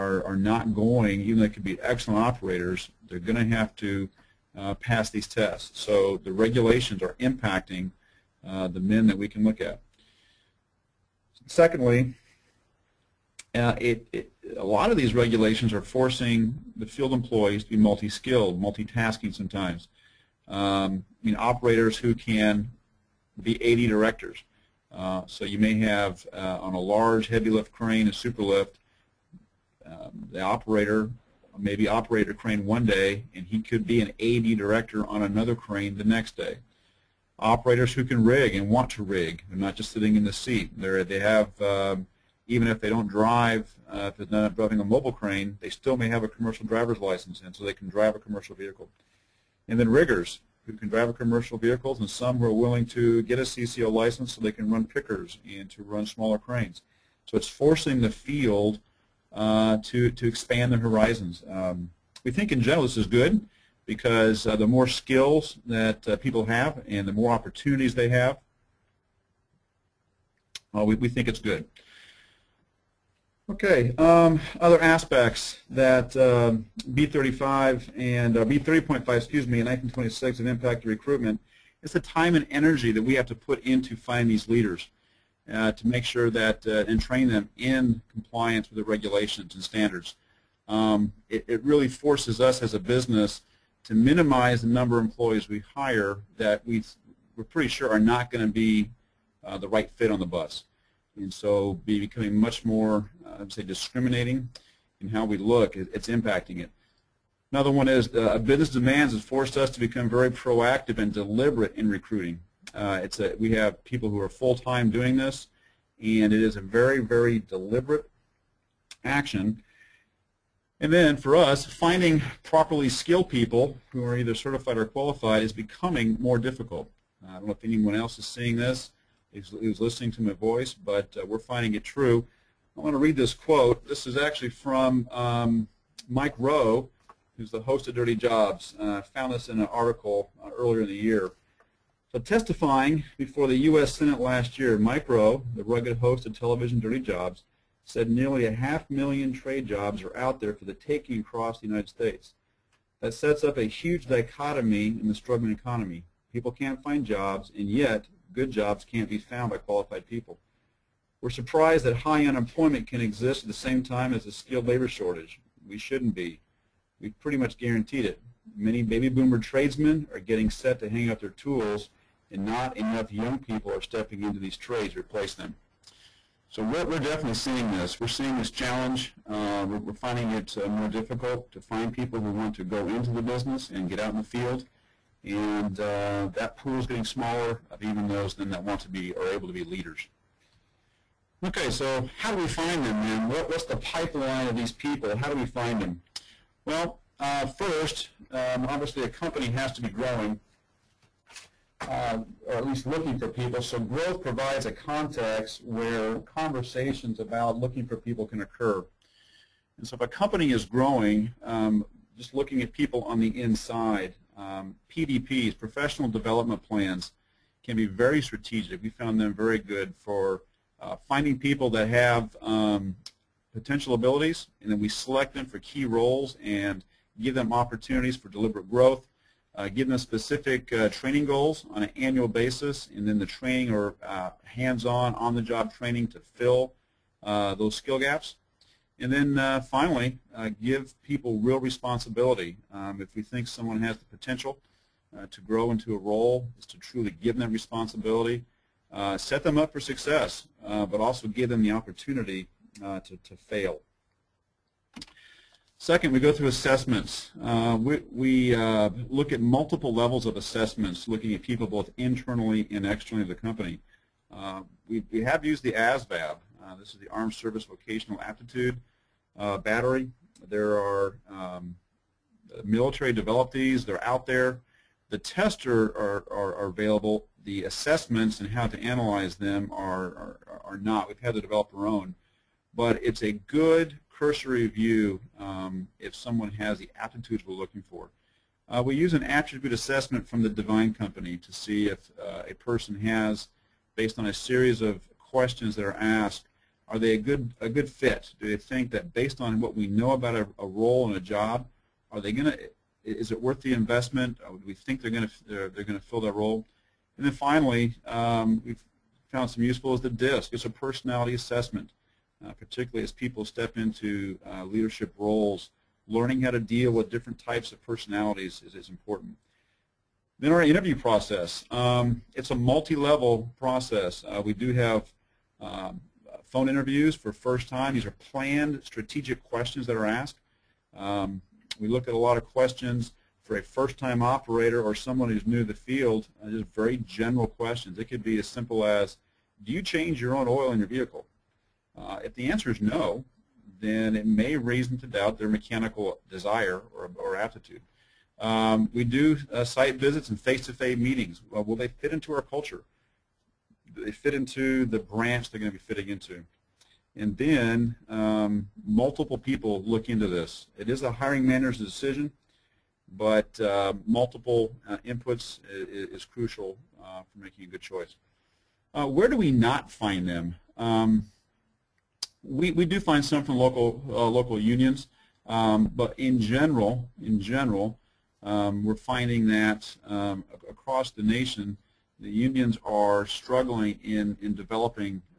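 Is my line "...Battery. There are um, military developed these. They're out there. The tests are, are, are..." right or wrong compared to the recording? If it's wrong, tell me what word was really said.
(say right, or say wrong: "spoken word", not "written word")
right.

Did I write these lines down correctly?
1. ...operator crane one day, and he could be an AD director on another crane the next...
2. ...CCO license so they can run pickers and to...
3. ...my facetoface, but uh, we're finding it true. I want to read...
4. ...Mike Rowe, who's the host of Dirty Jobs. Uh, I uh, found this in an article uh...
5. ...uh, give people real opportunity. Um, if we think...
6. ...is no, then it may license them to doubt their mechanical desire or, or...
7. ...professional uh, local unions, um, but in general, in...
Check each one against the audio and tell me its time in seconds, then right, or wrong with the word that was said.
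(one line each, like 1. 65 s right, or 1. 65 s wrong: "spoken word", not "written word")
1. 31 s right
2. 53 s right
3. 130 s wrong: "voice", not "facetoface"
4. 136 s right
5. 240 s wrong: "responsibility", not "opportunity"
6. 342 s wrong: "raise", not "license"
7. 373 s wrong: "local", not "professional".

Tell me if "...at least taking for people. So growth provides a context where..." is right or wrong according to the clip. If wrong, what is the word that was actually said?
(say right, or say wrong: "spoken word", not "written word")
wrong: "looking", not "taking".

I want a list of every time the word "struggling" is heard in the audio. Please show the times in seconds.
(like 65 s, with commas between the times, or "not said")
155 s, 383 s.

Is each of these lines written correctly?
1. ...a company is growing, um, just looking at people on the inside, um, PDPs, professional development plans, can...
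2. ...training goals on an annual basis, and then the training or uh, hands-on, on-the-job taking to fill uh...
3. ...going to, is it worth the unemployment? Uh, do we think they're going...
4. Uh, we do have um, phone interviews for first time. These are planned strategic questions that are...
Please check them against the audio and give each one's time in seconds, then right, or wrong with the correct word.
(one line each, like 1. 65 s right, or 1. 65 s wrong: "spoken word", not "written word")
1. 210 s right
2. 230 s wrong: "training", not "taking"
3. 302 s wrong: "investment", not "unemployment"
4. 324 s right.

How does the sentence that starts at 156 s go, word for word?
People can't find jobs, and yet good jobs can't be found by qualified people.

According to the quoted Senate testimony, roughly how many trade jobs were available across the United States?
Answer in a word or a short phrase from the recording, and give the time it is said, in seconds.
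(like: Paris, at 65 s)
half million, at 148 s.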